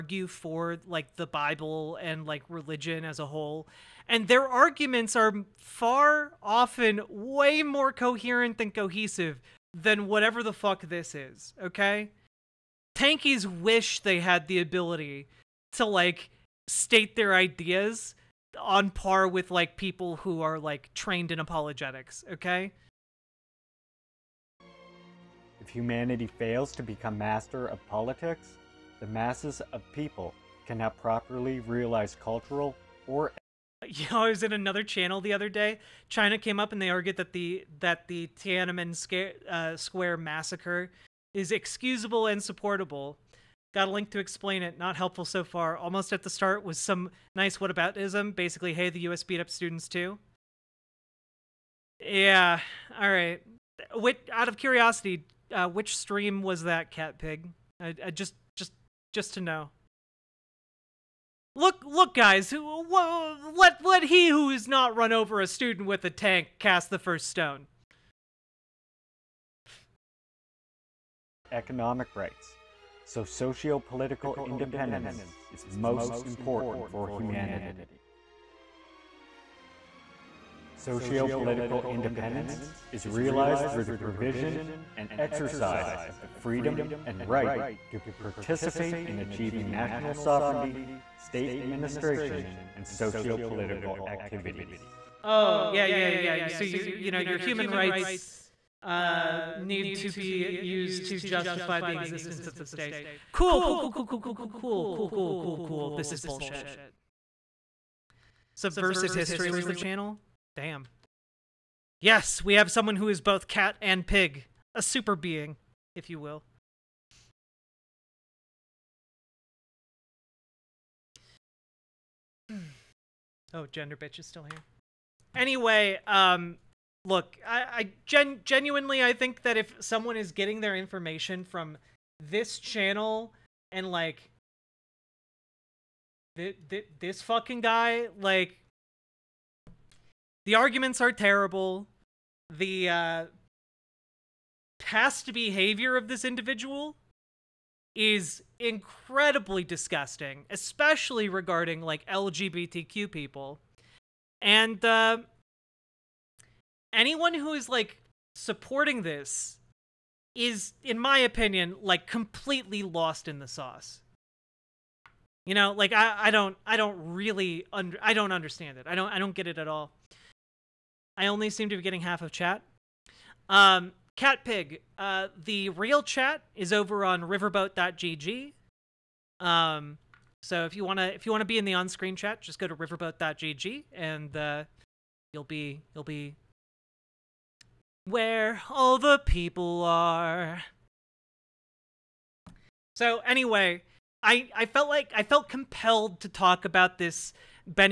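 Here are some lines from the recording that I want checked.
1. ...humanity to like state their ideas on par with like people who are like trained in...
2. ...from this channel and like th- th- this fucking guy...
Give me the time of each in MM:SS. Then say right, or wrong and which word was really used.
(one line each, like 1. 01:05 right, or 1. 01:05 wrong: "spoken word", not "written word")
1. 00:14 wrong: "ability", not "humanity"
2. 02:11 right.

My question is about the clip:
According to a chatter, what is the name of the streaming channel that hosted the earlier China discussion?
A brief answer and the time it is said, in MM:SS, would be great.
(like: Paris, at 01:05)
Subversive History, at 01:48.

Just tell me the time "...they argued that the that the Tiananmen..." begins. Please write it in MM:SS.
00:36.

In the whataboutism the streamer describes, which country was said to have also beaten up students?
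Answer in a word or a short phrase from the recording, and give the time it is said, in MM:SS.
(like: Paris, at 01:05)
U.S., at 00:49.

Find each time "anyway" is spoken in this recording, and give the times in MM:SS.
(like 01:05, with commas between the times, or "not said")
02:05, 03:13.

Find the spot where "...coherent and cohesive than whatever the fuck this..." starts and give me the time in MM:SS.
00:07.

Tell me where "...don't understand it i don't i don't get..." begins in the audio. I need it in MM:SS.
02:48.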